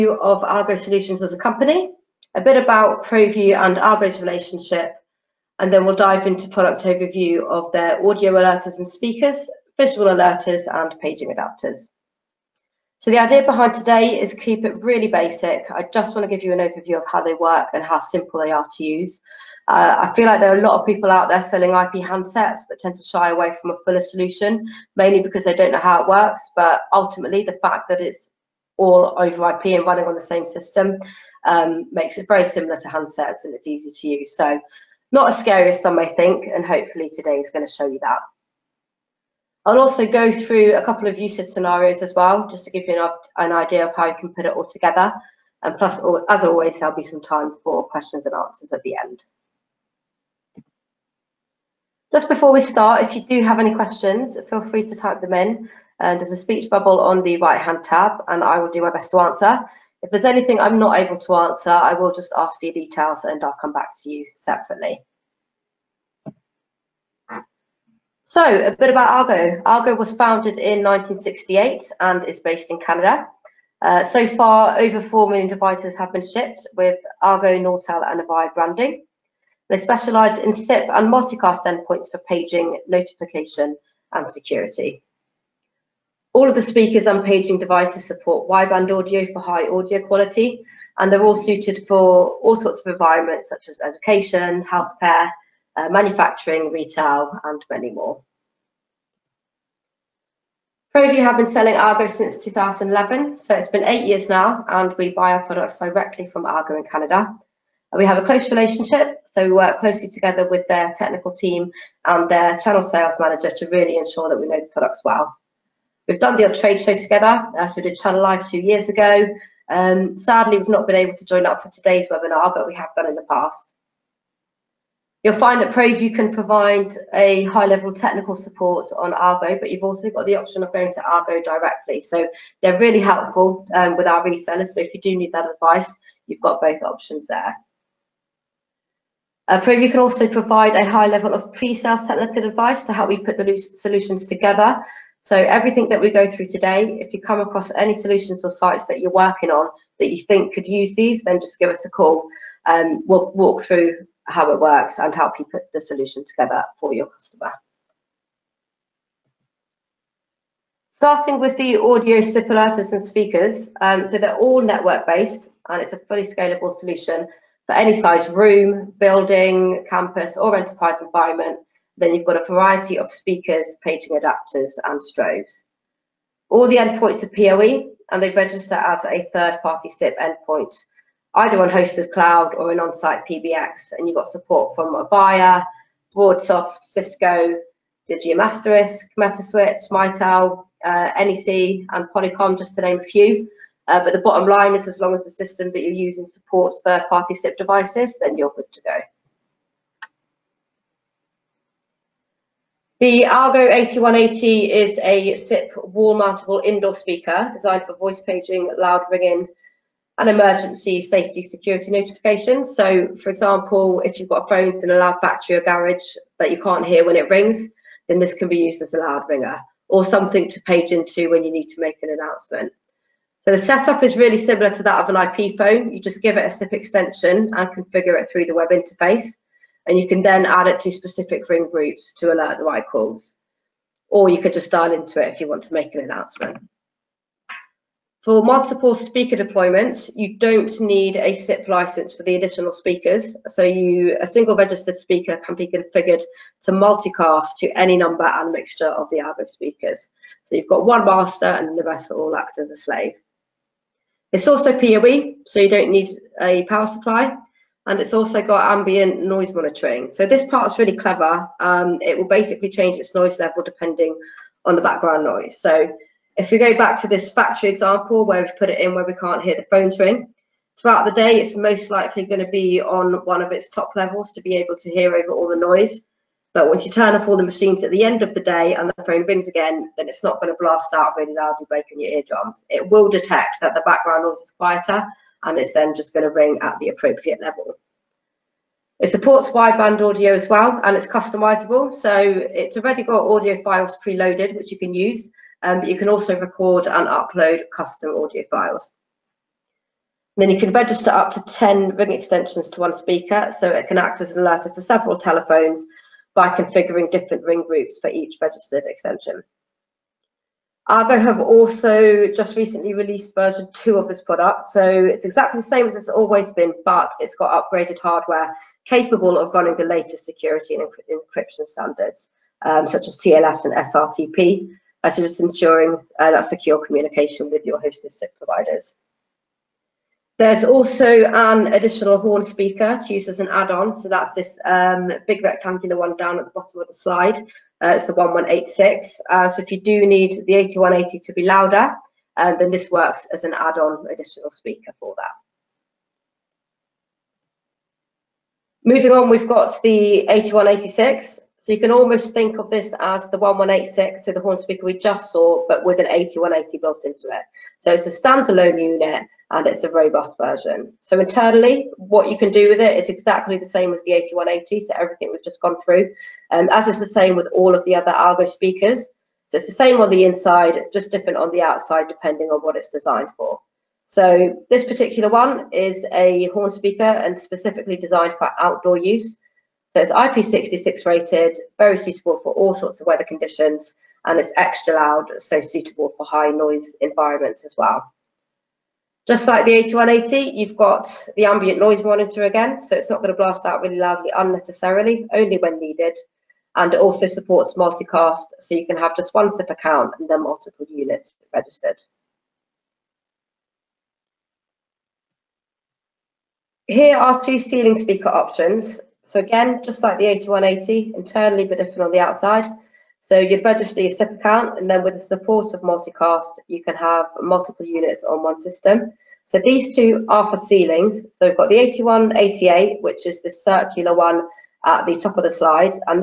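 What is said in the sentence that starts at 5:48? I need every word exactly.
Moving on, we've got the 8186.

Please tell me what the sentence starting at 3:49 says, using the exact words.
And you can then add it to specific ring groups to alert the right calls.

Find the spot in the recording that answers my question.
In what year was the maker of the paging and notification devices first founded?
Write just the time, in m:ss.
1:10.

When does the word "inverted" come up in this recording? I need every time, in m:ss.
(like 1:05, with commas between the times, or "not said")
not said.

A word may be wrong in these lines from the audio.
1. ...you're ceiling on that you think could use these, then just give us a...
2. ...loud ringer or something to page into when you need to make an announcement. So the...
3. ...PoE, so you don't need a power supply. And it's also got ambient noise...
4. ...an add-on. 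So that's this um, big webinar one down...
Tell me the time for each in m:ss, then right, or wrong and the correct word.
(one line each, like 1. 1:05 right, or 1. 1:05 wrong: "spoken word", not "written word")
1. 2:29 wrong: "working", not "ceiling"
2. 3:38 right
3. 4:14 right
4. 5:33 wrong: "rectangular", not "webinar".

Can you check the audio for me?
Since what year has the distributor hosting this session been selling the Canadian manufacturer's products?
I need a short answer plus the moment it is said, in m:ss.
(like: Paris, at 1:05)
2011, at 1:42.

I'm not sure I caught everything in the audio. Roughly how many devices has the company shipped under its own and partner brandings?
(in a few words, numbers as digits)
over 4 million.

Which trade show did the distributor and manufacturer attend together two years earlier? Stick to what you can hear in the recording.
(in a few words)
Channel Live.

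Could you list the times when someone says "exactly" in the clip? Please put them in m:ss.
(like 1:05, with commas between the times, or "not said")
5:15, 6:03.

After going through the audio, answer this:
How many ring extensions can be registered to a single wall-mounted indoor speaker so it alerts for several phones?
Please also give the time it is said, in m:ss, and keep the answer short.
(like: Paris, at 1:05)
10, at 5:01.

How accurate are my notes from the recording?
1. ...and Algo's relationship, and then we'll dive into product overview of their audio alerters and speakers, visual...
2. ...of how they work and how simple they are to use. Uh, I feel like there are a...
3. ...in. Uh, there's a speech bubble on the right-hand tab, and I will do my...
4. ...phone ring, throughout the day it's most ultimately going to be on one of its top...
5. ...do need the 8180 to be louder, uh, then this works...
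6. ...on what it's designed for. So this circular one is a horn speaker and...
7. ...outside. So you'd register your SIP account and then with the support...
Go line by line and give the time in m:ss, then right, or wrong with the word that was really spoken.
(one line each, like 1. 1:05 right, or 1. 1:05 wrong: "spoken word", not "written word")
1. 0:03 right
2. 0:16 right
3. 0:55 right
4. 4:29 wrong: "likely", not "ultimately"
5. 5:39 right
6. 6:12 wrong: "particular", not "circular"
7. 6:52 right.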